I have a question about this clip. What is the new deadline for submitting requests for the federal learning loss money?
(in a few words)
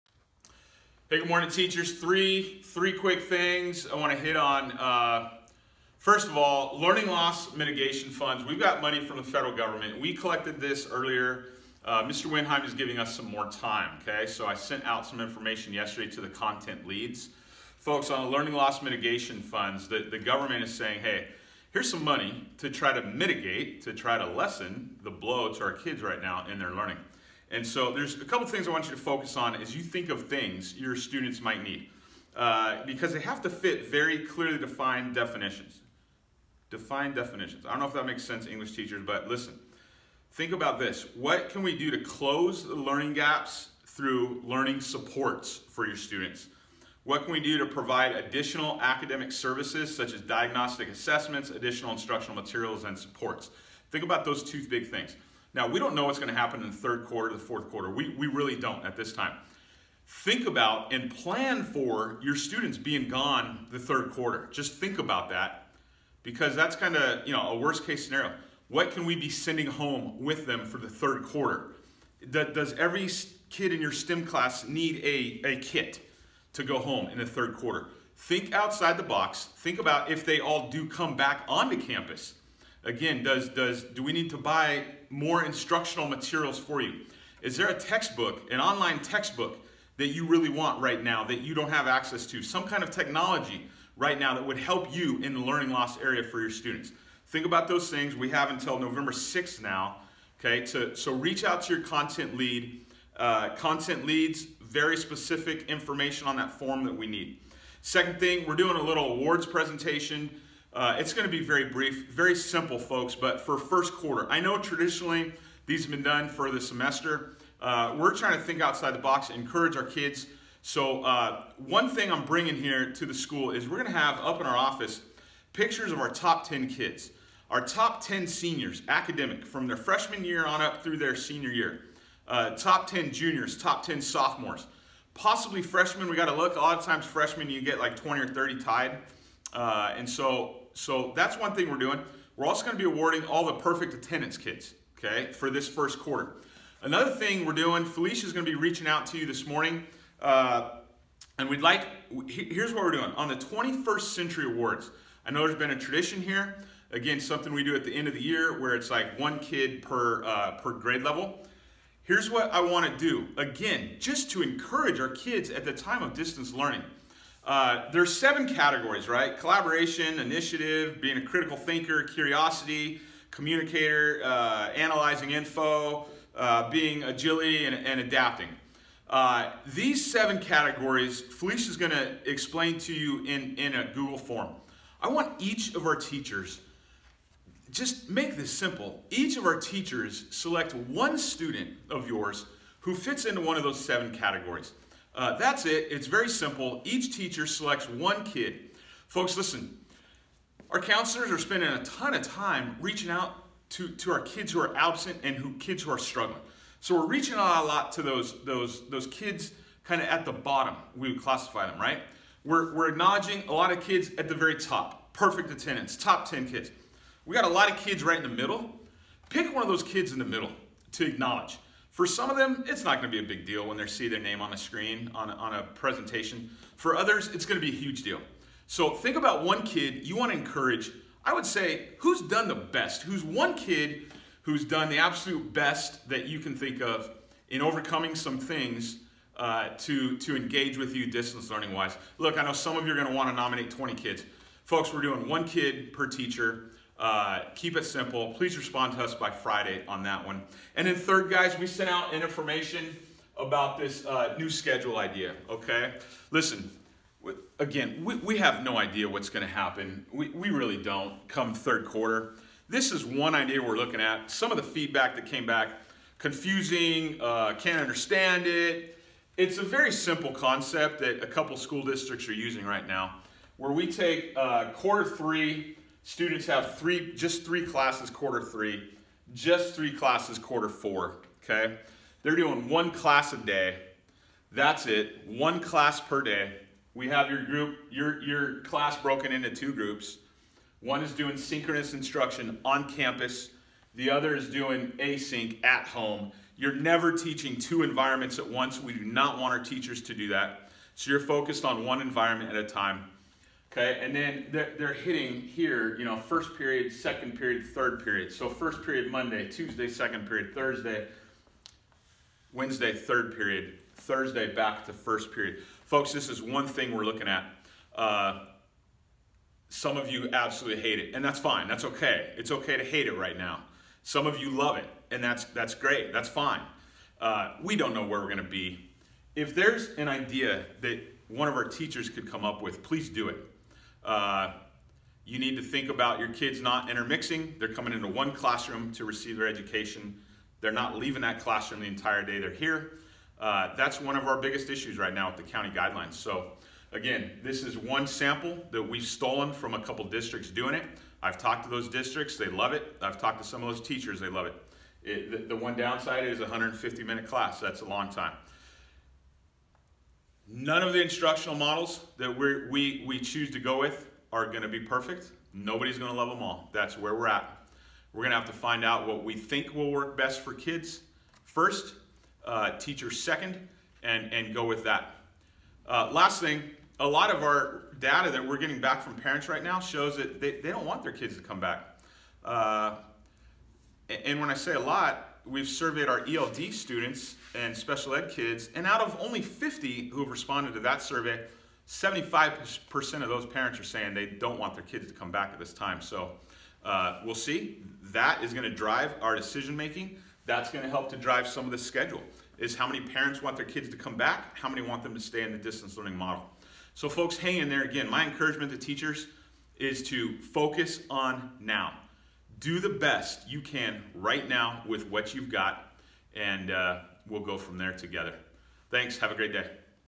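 November 6th.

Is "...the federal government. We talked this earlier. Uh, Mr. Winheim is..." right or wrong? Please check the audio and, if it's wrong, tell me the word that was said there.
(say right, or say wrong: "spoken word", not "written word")
wrong: "collected", not "talked".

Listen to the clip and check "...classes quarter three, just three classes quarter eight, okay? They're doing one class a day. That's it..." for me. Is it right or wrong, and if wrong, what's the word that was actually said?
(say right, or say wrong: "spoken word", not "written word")
wrong: "four", not "eight".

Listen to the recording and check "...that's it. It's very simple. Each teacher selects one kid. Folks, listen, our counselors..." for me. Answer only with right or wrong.
right.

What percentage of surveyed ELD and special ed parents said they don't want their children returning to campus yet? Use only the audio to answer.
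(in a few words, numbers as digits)
75%.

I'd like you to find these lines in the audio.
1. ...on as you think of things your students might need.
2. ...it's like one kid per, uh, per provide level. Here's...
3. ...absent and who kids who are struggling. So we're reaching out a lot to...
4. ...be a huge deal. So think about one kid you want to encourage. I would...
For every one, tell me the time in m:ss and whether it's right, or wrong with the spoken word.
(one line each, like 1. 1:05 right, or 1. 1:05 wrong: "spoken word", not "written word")
1. 0:29 right
2. 2:38 wrong: "grade", not "provide"
3. 3:24 right
4. 3:47 right.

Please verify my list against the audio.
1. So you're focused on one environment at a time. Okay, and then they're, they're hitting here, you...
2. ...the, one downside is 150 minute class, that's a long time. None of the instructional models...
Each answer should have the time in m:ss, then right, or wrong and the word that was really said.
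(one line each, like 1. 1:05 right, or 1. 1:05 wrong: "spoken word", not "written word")
1. 5:00 right
2. 5:55 right.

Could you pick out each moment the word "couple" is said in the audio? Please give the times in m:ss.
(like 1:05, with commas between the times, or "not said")
0:28, 4:31, 5:49.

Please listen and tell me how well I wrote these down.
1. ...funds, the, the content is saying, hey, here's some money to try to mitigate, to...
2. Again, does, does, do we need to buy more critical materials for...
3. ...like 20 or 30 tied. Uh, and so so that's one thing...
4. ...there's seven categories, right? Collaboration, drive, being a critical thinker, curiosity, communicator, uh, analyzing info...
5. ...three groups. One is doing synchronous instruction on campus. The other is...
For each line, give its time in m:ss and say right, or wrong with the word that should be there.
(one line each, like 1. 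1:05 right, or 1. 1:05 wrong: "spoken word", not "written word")
1. 0:19 wrong: "government", not "content"
2. 1:22 wrong: "instructional", not "critical"
3. 2:17 right
4. 2:47 wrong: "initiative", not "drive"
5. 4:49 wrong: "two", not "three".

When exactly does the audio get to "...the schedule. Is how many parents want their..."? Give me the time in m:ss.
6:41.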